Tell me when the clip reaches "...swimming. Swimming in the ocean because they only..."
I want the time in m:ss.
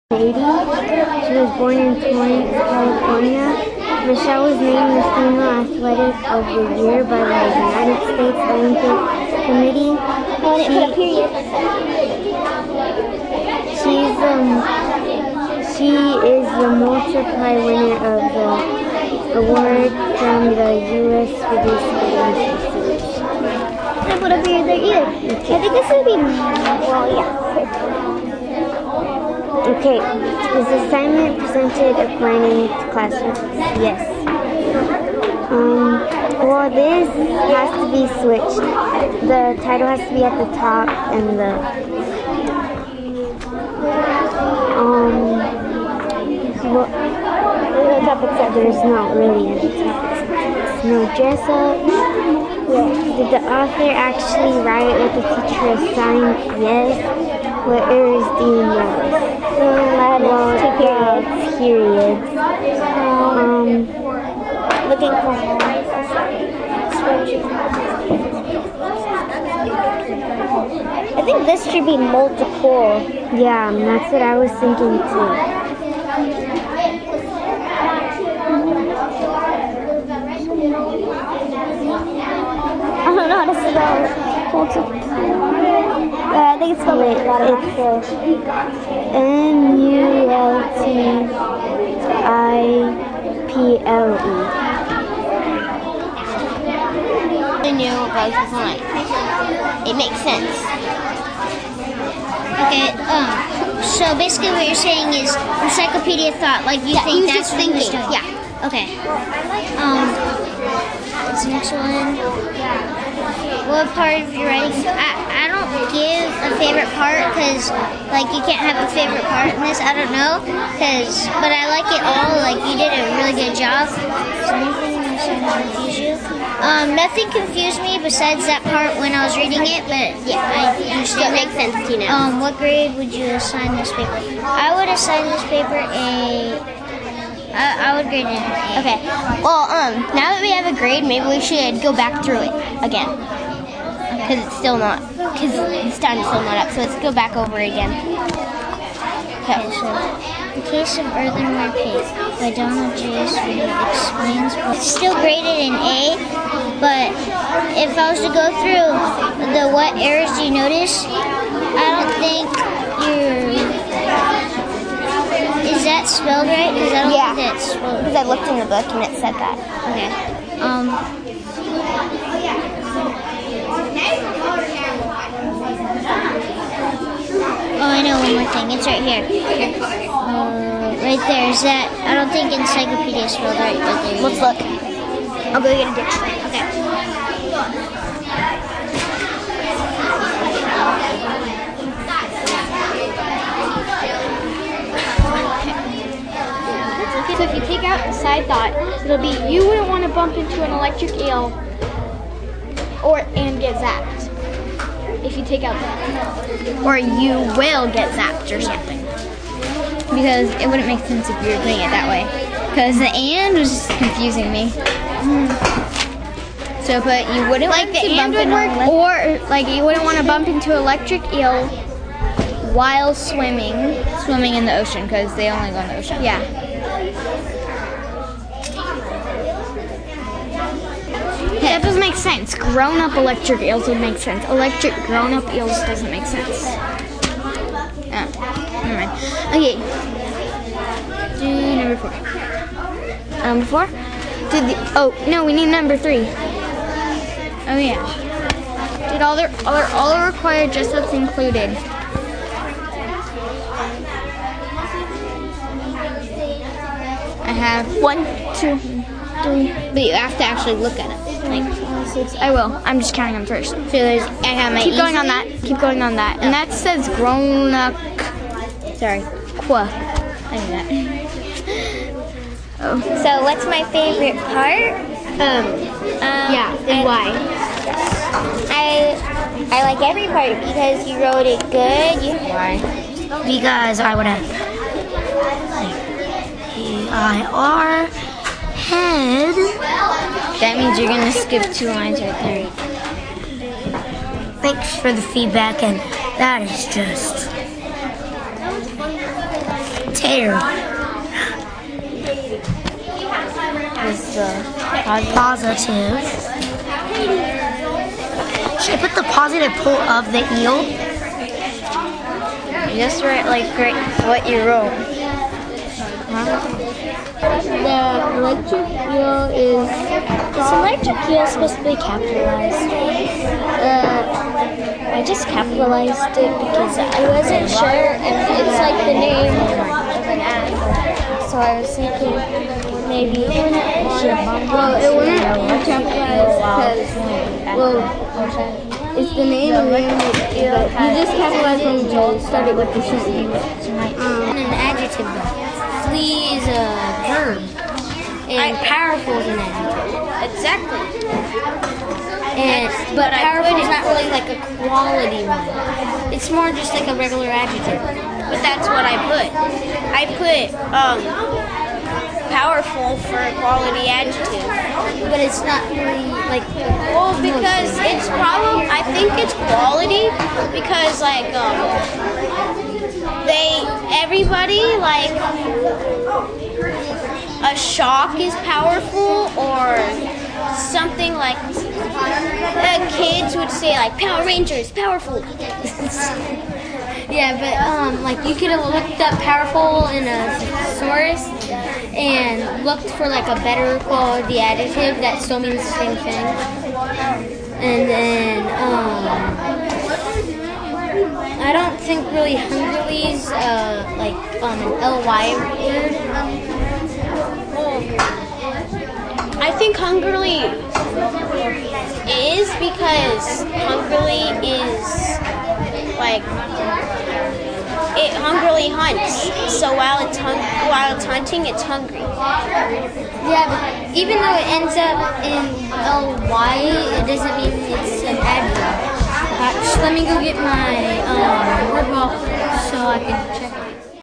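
3:43.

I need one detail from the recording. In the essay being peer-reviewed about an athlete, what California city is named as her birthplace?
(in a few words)
Torrance.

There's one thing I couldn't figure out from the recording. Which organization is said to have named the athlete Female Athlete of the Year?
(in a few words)
United States Olympic Committee.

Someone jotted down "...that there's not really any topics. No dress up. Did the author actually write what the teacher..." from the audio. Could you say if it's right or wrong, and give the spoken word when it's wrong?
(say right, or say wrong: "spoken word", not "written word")
right.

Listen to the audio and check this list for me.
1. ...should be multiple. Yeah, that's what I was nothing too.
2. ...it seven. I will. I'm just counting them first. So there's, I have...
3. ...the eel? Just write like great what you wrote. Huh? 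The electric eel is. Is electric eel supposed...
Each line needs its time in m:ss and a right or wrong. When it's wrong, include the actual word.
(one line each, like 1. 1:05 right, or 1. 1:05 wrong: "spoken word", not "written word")
1. 1:11 wrong: "thinking", not "nothing"
2. 4:21 wrong: "six", not "seven"
3. 5:10 right.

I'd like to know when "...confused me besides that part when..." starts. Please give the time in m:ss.
2:07.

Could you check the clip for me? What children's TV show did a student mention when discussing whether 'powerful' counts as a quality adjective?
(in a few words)
Power Rangers.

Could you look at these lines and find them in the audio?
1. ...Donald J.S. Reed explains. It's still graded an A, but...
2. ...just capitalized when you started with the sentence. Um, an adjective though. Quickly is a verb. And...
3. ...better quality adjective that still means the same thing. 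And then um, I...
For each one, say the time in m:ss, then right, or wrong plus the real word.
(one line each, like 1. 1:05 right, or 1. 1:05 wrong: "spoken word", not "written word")
1. 2:32 right
2. 5:41 right
3. 6:33 right.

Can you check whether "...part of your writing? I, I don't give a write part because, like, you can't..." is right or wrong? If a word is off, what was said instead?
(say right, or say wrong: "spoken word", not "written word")
wrong: "favorite", not "write".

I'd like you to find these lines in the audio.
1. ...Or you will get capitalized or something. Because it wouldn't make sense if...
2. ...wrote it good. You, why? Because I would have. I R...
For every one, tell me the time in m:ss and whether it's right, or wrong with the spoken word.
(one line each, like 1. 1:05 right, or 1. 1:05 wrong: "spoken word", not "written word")
1. 3:26 wrong: "zapped", not "capitalized"
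2. 4:41 right.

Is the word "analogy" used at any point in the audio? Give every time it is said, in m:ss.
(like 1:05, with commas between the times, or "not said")
not said.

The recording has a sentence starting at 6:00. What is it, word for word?
I put um, powerful for a quality adjective.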